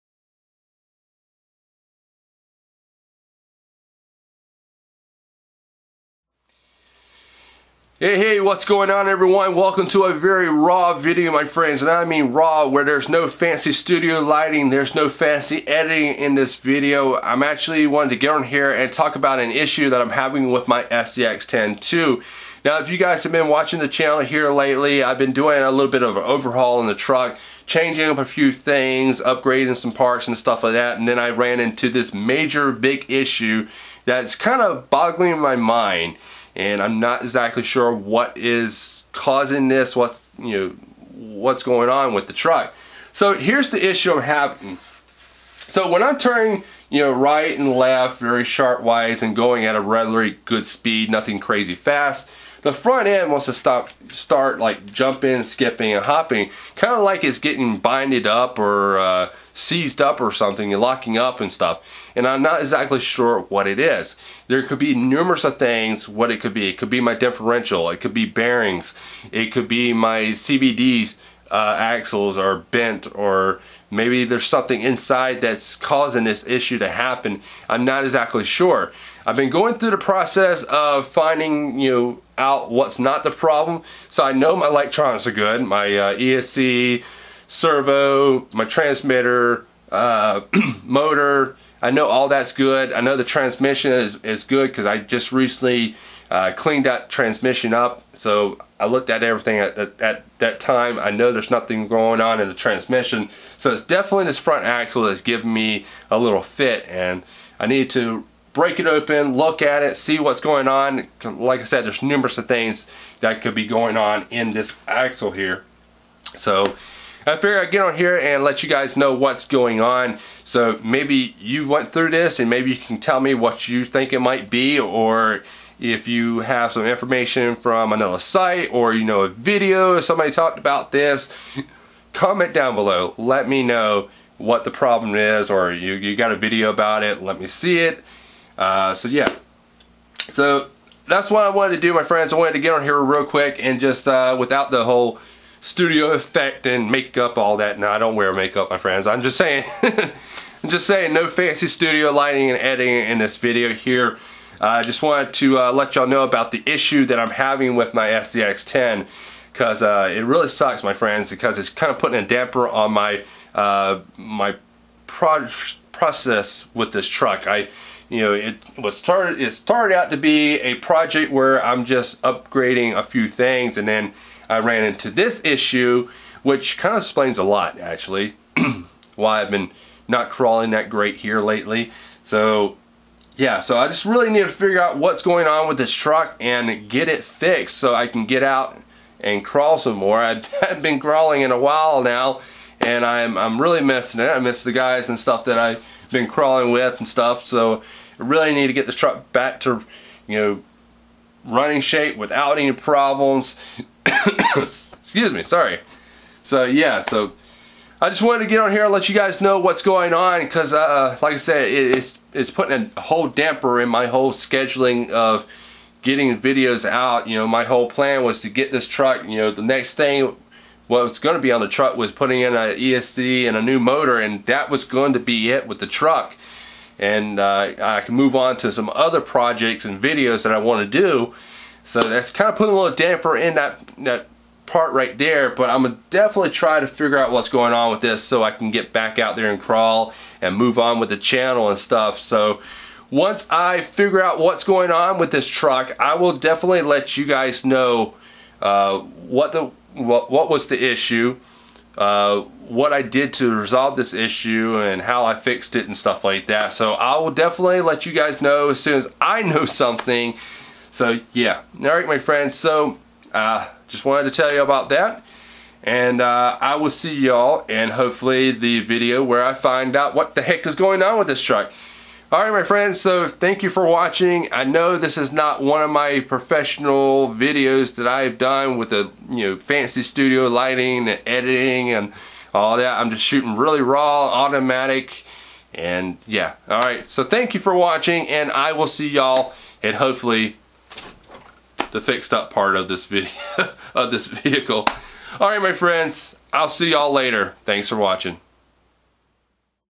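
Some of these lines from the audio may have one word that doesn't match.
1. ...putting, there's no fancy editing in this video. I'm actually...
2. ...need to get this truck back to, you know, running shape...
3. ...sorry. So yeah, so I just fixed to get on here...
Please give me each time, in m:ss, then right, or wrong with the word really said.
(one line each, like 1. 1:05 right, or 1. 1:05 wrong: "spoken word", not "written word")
1. 0:14 wrong: "lighting", not "putting"
2. 3:18 right
3. 3:25 wrong: "wanted", not "fixed".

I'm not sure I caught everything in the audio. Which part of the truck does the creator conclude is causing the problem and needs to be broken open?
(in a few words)
front axle.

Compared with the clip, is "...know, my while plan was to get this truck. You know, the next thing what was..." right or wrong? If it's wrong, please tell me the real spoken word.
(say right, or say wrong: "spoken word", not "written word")
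wrong: "whole", not "while".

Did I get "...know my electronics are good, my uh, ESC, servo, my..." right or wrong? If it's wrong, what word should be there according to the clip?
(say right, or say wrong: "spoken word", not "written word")
right.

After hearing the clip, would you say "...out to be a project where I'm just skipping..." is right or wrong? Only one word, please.
wrong.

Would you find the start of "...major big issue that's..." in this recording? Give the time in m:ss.
0:32.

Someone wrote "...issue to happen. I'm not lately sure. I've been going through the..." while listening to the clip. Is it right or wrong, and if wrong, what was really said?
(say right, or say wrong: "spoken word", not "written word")
wrong: "exactly", not "lately".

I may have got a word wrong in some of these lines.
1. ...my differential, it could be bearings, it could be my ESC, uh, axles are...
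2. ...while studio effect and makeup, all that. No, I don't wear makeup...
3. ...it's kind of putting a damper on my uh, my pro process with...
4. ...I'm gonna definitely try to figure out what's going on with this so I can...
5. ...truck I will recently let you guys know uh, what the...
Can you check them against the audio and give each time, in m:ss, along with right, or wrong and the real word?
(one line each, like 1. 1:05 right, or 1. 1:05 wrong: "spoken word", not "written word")
1. 1:07 wrong: "CVDs", not "ESC"
2. 2:24 wrong: "whole", not "while"
3. 2:41 right
4. 3:55 right
5. 4:05 wrong: "definitely", not "recently".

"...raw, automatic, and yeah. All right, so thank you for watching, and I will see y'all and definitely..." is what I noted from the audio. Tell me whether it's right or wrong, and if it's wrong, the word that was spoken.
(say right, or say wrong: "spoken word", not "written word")
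wrong: "hopefully", not "definitely".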